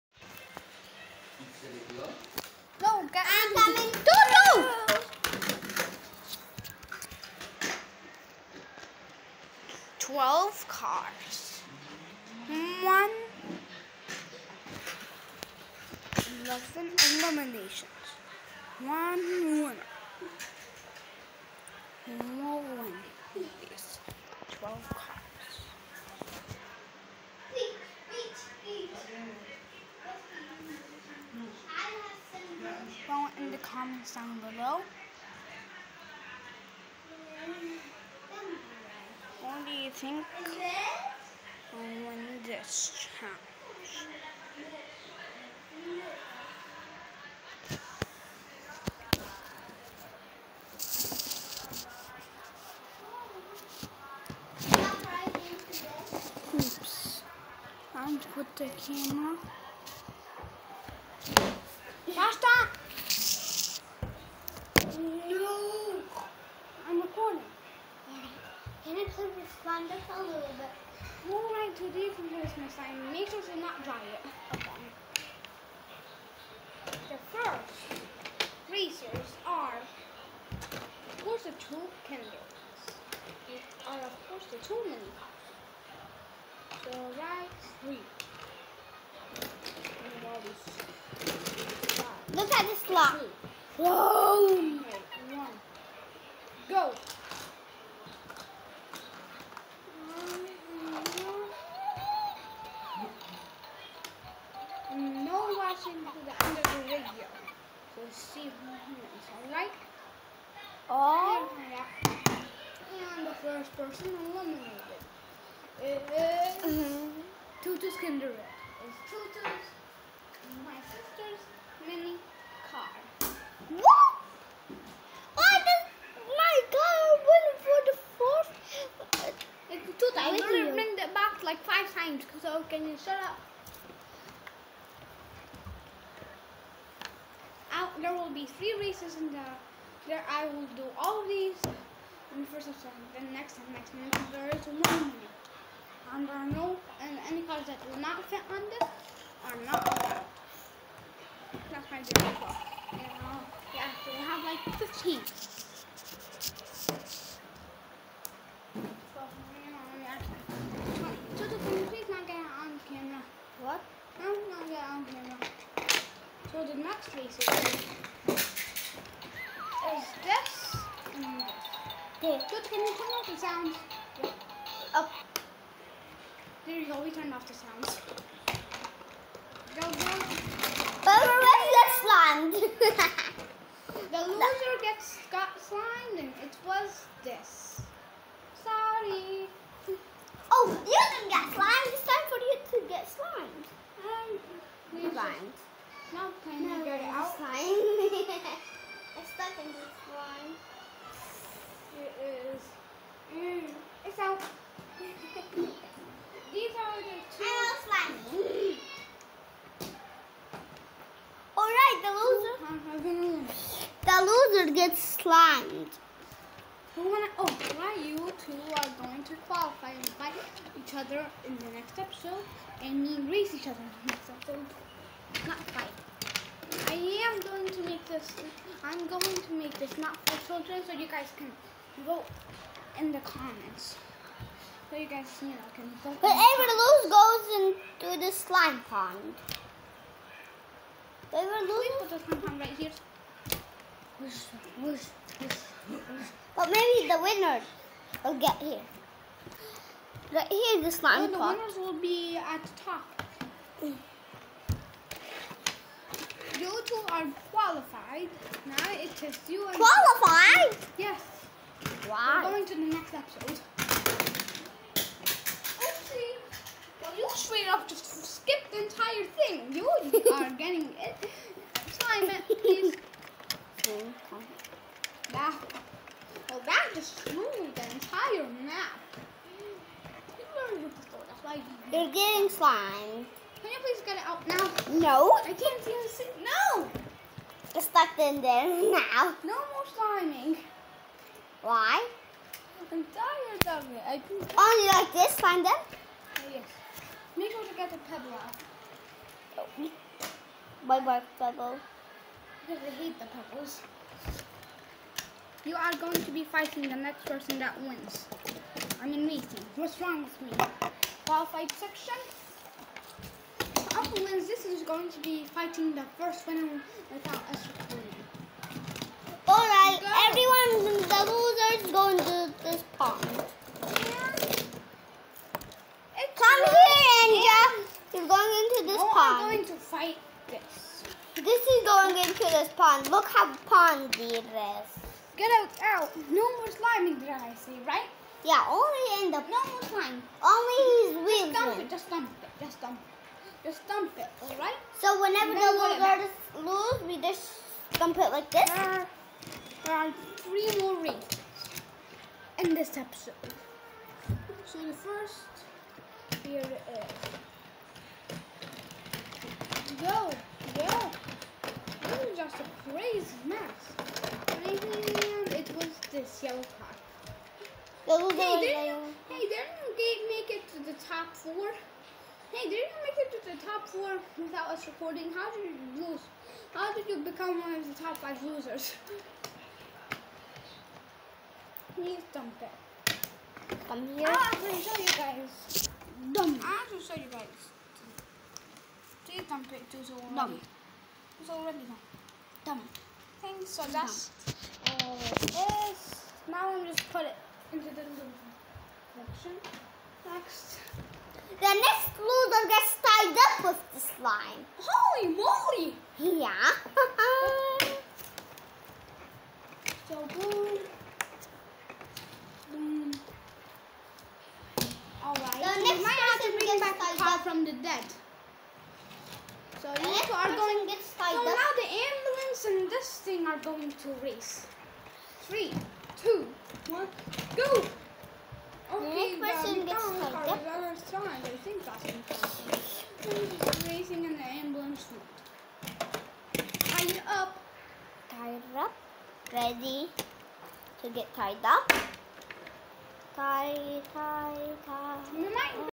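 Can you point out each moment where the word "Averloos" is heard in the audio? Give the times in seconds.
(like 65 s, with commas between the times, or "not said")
236 s, 241 s.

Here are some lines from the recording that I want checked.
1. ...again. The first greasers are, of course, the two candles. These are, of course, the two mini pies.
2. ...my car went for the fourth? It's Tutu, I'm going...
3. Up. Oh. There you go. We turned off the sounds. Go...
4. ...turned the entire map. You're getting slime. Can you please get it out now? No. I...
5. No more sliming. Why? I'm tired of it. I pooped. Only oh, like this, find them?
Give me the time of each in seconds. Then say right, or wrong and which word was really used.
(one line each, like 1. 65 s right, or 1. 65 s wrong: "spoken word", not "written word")
1. 74 s right
2. 126 s right
3. 174 s right
4. 277 s wrong: "ruined", not "turned"
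5. 289 s right.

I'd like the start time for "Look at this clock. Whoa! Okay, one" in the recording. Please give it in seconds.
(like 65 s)
92 s.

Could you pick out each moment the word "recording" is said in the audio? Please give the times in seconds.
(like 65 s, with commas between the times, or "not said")
317 s, 374 s.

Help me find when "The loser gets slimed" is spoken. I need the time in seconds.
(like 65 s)
214 s.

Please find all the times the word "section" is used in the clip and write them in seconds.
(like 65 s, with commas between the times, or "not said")
311 s.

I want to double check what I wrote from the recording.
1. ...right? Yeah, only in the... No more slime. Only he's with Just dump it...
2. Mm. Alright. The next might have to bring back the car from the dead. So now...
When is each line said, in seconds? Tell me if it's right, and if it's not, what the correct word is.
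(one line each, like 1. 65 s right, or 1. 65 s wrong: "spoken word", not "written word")
1. 337 s right
2. 412 s right.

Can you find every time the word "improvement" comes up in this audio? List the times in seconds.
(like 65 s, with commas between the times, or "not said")
not said.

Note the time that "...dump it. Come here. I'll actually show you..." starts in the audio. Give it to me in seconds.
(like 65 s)
382 s.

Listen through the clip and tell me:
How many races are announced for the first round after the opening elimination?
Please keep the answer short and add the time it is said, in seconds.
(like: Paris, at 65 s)
3, at 138 s.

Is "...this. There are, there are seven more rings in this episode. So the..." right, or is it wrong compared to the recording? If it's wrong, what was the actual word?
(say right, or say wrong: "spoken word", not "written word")
wrong: "three", not "seven".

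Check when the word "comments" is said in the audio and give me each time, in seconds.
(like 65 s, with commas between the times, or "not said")
33 s, 233 s.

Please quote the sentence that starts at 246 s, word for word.
But maybe the winner will get here.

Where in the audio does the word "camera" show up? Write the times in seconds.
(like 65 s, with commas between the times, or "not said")
58 s, 165 s.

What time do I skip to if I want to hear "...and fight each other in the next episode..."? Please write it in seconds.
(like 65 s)
219 s.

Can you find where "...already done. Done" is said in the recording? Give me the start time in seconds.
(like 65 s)
391 s.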